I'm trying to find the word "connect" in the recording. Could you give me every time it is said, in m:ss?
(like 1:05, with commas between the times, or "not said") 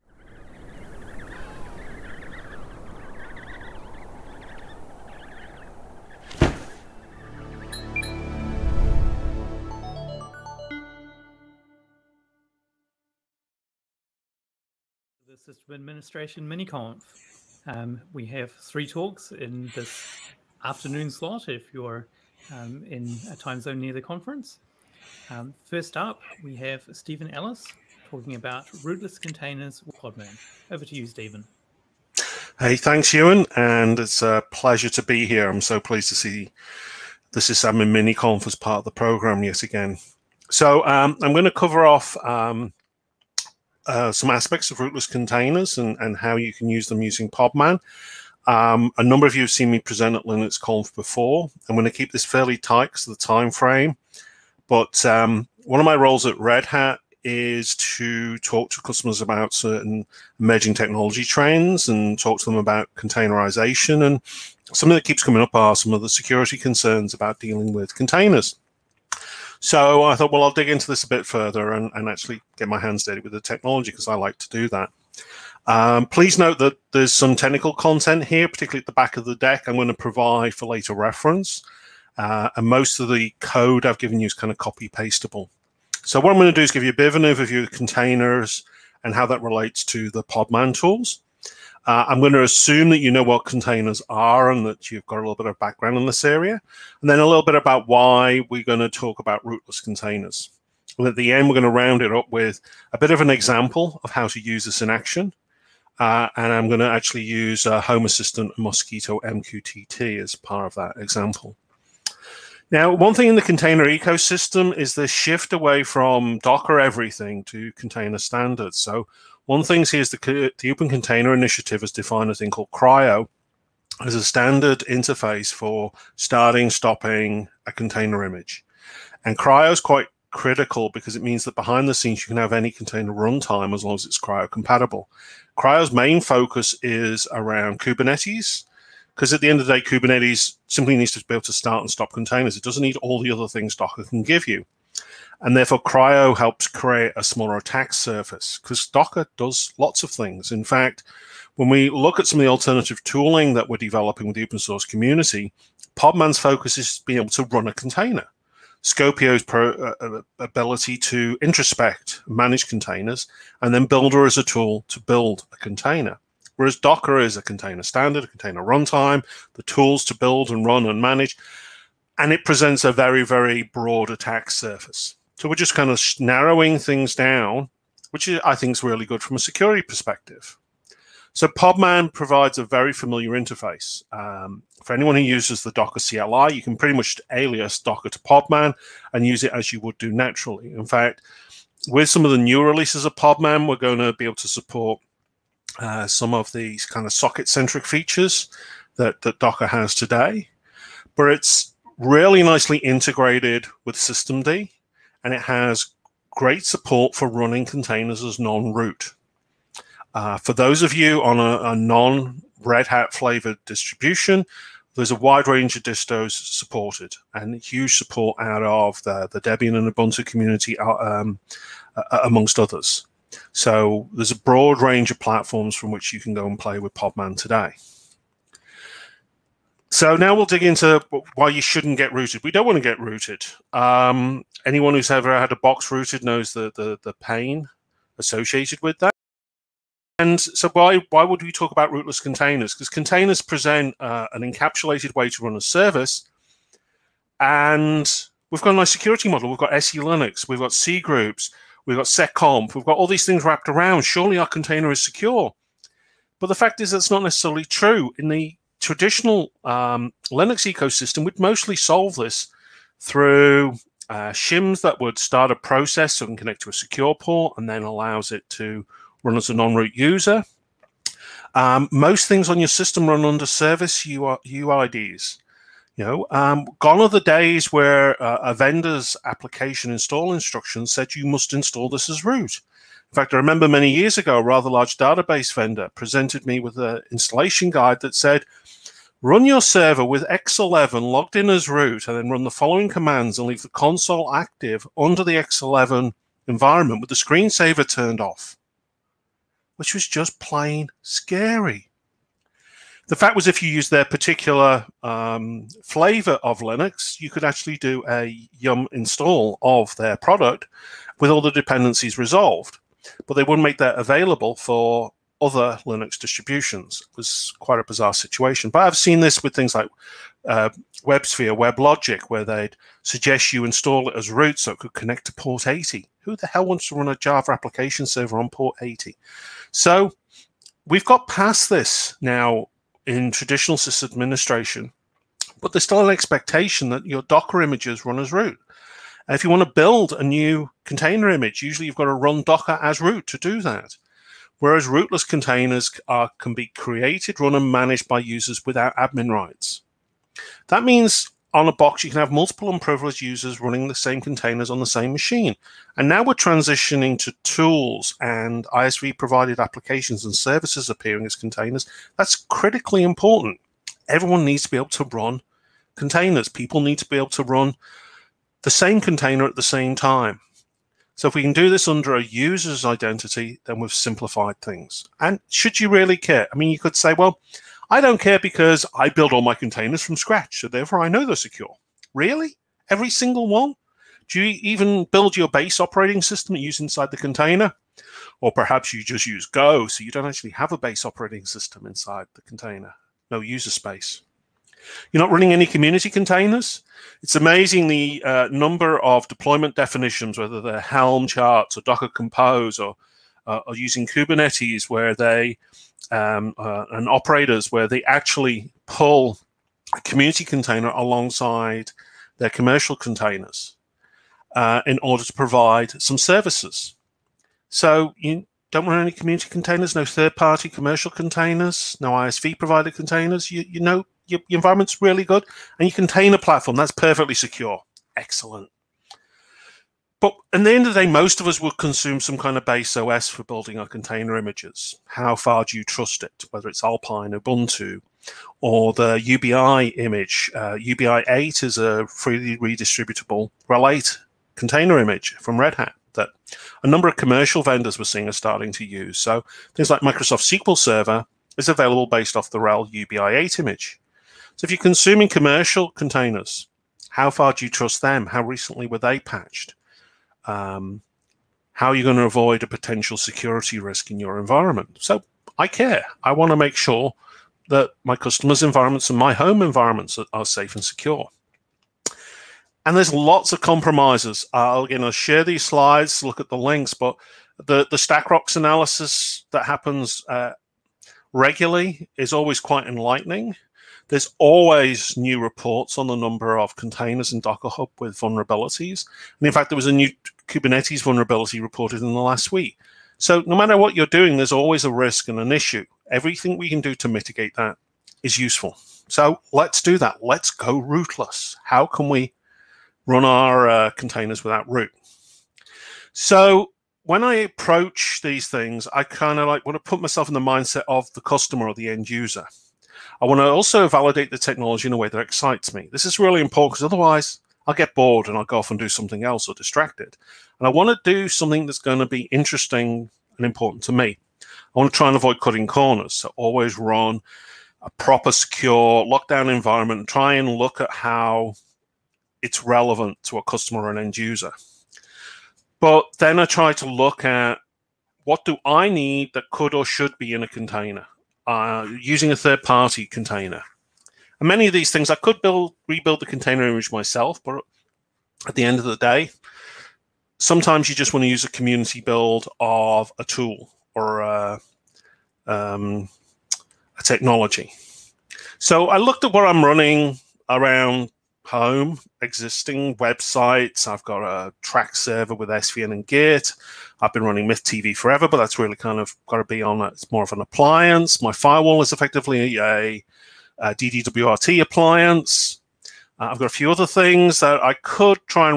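4:26, 5:24.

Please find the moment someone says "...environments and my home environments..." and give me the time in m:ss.
7:48.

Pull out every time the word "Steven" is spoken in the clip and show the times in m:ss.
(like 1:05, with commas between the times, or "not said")
0:26, 0:31.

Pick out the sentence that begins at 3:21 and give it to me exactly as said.
But it's really nicely integrated with systemd and it has great support for running containers as non-root.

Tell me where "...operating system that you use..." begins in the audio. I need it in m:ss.
6:25.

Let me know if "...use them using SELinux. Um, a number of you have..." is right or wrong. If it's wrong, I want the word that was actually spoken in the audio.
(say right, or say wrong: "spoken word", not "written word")
wrong: "Podman", not "SELinux".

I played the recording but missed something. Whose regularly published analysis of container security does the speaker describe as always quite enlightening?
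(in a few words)
StackRox.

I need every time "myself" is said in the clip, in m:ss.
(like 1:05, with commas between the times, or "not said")
8:30, 9:06.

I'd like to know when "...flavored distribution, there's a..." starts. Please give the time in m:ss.
3:33.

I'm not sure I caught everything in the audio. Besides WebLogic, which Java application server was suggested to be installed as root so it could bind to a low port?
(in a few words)
WebSphere.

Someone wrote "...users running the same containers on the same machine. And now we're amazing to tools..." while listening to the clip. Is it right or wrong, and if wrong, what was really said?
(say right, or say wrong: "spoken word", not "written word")
wrong: "transitioning", not "amazing".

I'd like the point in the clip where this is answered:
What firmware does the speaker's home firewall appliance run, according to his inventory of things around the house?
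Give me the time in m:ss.
9:33.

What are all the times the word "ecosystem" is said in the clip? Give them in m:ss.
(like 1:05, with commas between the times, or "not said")
1:53, 4:20.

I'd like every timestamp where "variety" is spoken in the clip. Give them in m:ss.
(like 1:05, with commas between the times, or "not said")
not said.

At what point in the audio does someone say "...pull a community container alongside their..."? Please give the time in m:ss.
6:48.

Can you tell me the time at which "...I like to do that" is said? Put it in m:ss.
1:14.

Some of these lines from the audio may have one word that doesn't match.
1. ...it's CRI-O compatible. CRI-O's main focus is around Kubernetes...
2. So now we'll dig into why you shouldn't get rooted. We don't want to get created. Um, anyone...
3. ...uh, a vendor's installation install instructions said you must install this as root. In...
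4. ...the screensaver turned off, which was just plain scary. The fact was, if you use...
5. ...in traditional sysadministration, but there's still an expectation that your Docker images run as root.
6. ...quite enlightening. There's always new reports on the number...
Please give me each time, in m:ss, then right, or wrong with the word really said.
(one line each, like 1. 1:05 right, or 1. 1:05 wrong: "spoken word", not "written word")
1. 2:14 right
2. 3:49 wrong: "rooted", not "created"
3. 4:38 wrong: "application", not "installation"
4. 4:57 right
5. 5:33 right
6. 8:02 right.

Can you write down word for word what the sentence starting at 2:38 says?
Skopeo's pro, uh, ability to introspect, manage containers, and then Buildah is a tool to build a container.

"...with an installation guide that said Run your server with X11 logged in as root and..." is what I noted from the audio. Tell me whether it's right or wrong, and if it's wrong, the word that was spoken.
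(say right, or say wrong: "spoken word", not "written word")
right.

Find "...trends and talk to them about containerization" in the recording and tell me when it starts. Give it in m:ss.
1:01.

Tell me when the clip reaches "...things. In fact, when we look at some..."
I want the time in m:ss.
2:30.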